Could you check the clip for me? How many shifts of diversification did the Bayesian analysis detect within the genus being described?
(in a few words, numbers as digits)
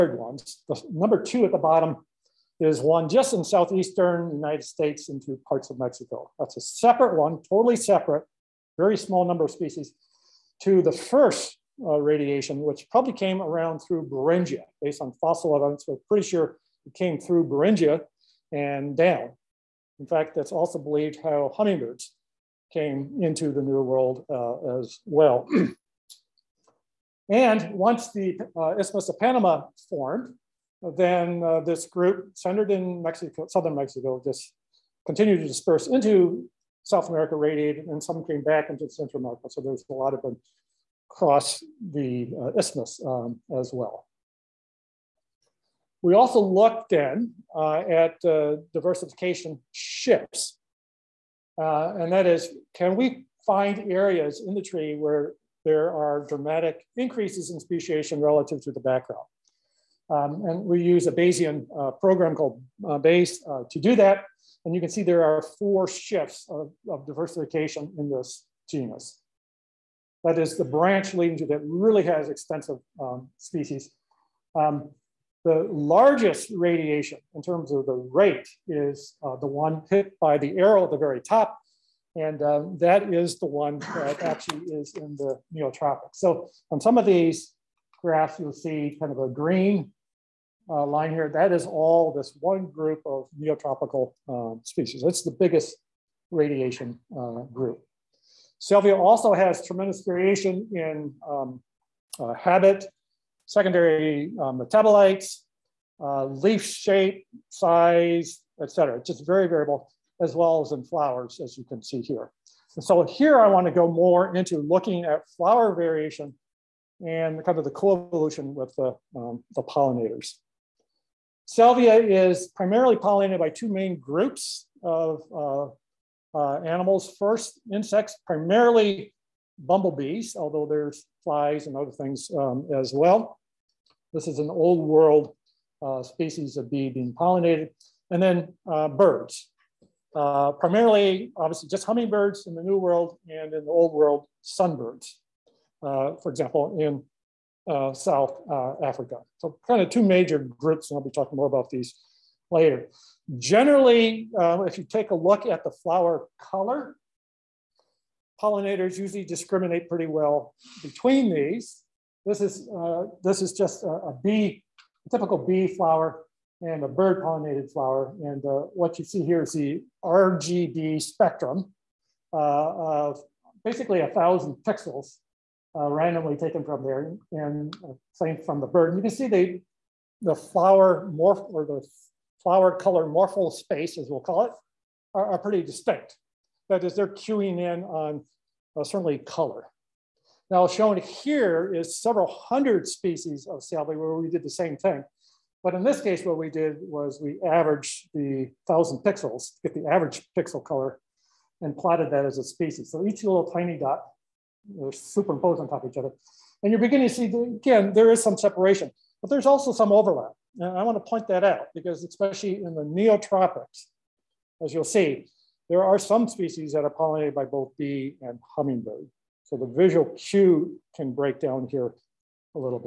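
4.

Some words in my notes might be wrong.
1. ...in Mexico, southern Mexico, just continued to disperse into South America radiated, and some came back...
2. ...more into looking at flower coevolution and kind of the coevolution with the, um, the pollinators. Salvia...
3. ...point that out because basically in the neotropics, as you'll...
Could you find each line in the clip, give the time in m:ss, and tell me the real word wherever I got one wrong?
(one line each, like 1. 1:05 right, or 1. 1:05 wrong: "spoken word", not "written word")
1. 0:32 right
2. 1:53 wrong: "variation", not "coevolution"
3. 3:31 wrong: "especially", not "basically".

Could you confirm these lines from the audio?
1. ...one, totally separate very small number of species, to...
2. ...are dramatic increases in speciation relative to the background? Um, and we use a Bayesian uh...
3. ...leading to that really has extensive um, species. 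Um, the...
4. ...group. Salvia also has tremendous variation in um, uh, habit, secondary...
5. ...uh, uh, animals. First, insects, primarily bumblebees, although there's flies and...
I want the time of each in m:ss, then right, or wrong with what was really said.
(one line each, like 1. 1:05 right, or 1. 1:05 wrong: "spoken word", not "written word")
1. 0:07 right
2. 0:55 right
3. 1:11 right
4. 1:37 right
5. 2:05 right.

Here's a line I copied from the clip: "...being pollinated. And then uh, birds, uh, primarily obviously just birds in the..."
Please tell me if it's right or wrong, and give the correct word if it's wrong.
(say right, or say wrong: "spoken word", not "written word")
wrong: "hummingbirds", not "birds".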